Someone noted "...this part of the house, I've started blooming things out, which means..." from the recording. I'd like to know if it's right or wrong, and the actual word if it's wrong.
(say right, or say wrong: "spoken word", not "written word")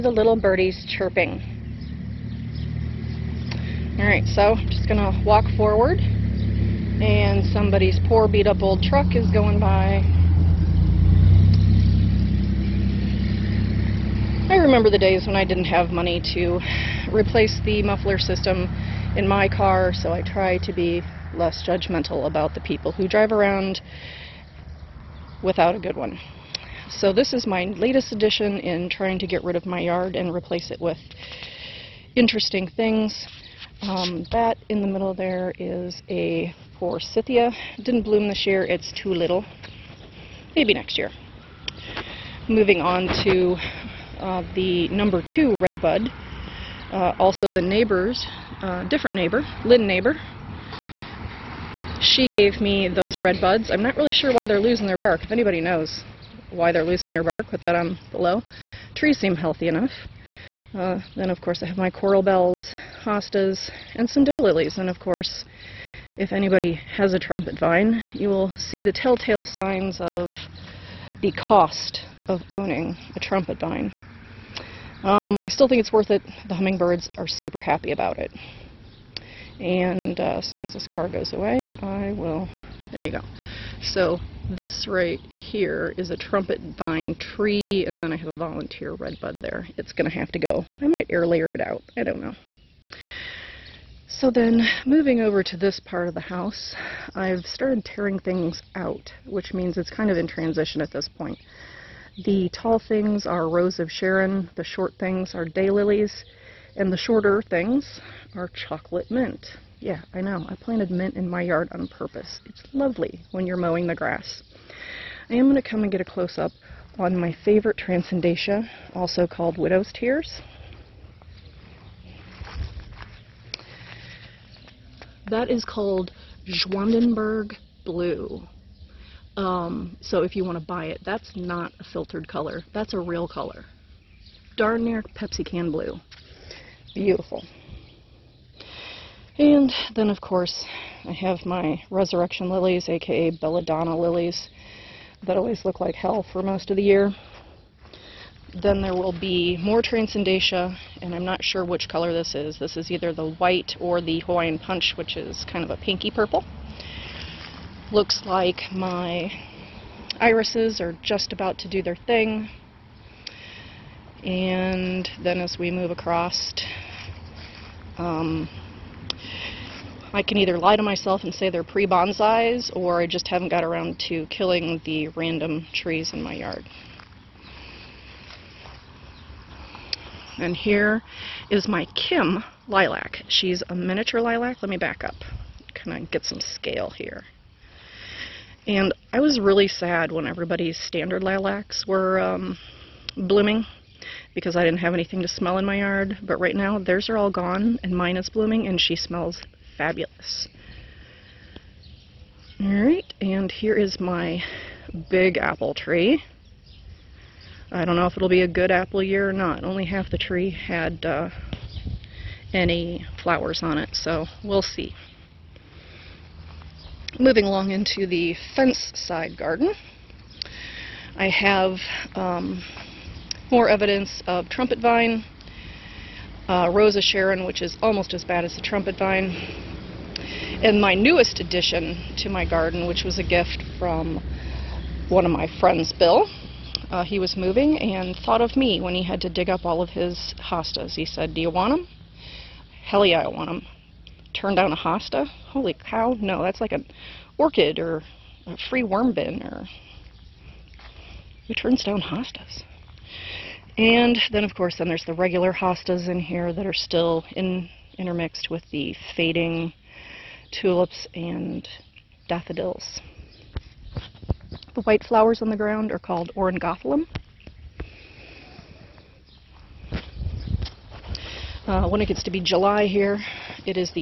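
wrong: "tearing", not "blooming".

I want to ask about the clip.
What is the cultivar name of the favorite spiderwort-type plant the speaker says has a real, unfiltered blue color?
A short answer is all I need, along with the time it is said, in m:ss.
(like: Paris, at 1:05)
Zwanenburg Blue, at 2:06.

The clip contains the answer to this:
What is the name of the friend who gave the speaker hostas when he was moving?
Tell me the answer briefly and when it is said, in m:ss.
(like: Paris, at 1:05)
Bill, at 3:55.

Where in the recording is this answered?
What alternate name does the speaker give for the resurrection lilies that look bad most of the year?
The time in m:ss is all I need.
2:23.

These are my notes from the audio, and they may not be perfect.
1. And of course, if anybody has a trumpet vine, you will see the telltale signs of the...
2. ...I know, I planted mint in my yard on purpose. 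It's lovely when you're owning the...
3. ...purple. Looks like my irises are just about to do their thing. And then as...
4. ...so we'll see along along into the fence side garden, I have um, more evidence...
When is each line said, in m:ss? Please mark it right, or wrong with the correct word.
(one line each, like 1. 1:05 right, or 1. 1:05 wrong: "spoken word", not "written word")
1. 1:04 right
2. 1:50 wrong: "mowing", not "owning"
3. 2:36 right
4. 3:33 wrong: "moving", not "along".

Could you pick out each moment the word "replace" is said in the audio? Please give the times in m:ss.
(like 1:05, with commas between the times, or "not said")
0:17, 0:30.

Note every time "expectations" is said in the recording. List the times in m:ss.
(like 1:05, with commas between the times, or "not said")
not said.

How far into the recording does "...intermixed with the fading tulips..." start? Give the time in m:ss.
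4:17.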